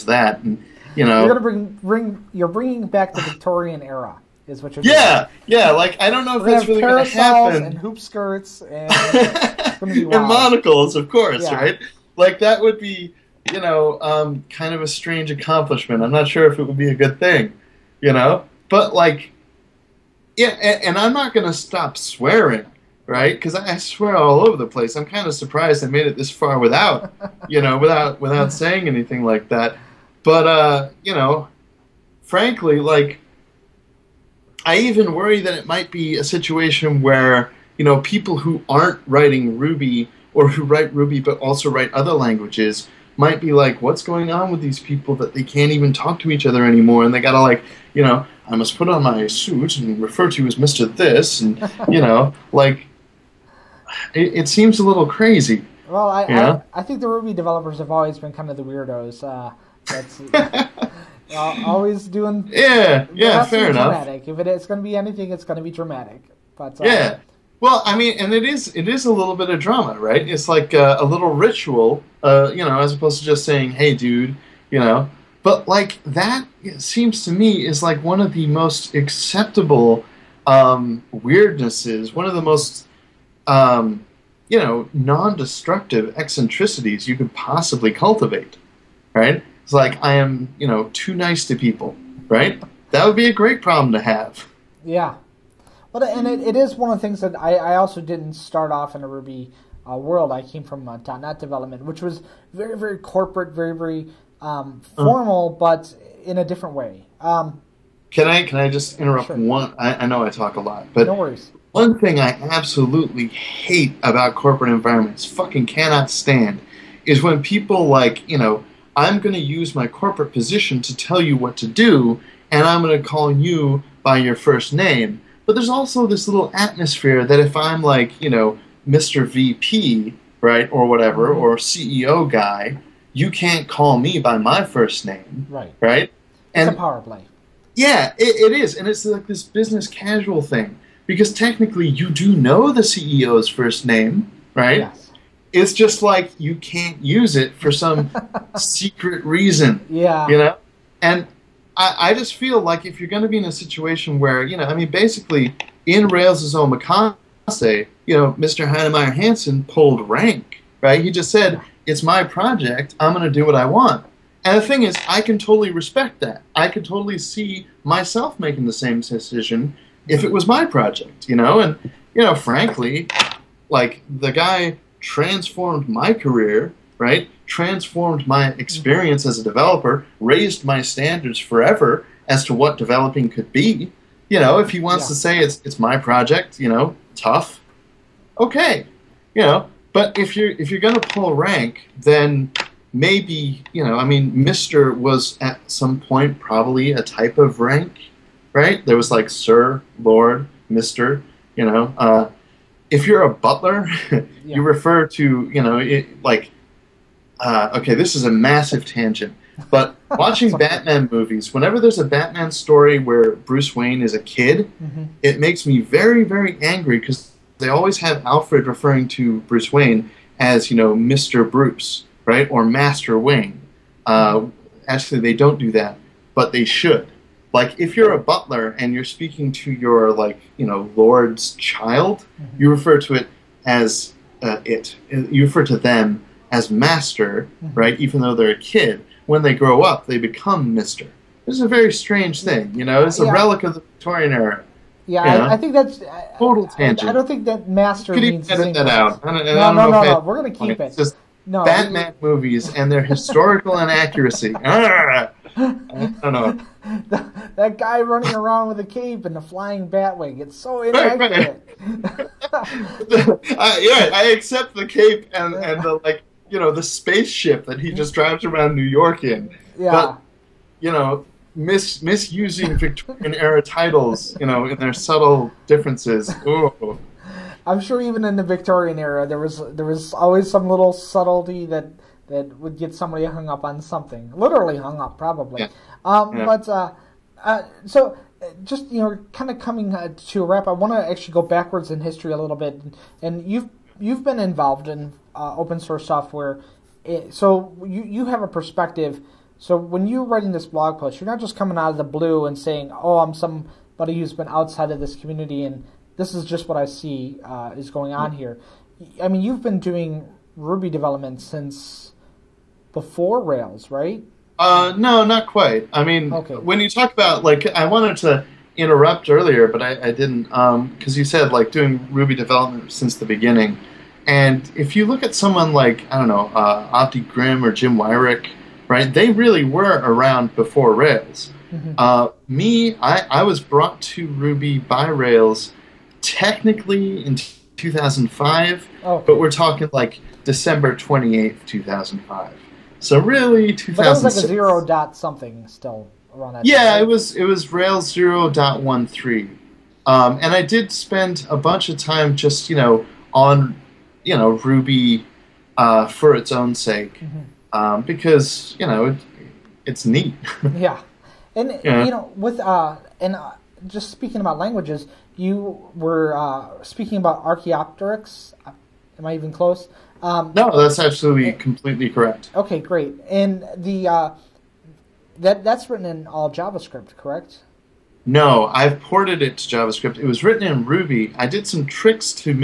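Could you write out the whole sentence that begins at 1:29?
It's like I am, you know, too nice to people, right?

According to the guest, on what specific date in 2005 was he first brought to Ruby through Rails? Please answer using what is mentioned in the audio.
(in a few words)
December 28th.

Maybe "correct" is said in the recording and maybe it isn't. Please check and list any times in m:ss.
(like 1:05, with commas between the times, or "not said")
6:12, 6:17.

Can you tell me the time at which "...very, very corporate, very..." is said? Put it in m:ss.
1:42.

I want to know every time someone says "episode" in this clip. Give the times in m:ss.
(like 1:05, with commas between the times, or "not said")
not said.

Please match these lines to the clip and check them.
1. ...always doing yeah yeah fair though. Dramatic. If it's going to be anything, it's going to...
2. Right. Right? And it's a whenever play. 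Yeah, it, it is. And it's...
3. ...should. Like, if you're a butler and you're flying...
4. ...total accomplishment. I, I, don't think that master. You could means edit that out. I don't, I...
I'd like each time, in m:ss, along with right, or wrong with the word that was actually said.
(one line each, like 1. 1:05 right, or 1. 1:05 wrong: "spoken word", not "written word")
1. 1:01 wrong: "enough", not "though"
2. 2:15 wrong: "power", not "whenever"
3. 3:46 wrong: "speaking", not "flying"
4. 4:06 wrong: "tangent", not "accomplishment".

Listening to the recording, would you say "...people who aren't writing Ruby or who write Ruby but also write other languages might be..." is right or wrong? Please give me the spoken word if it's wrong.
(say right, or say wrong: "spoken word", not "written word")
right.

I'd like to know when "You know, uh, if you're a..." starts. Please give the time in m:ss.
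3:21.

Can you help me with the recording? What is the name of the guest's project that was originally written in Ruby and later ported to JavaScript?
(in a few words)
Archaeopteryx.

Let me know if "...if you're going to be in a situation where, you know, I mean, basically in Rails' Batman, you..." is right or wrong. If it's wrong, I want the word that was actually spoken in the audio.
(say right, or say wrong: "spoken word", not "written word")
wrong: "Omakase", not "Batman".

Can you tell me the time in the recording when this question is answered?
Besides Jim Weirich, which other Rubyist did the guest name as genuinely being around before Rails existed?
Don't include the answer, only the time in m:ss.
5:27.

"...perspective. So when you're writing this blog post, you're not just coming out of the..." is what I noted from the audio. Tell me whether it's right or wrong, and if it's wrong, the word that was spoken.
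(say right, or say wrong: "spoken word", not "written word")
right.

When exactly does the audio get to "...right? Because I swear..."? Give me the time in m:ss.
0:23.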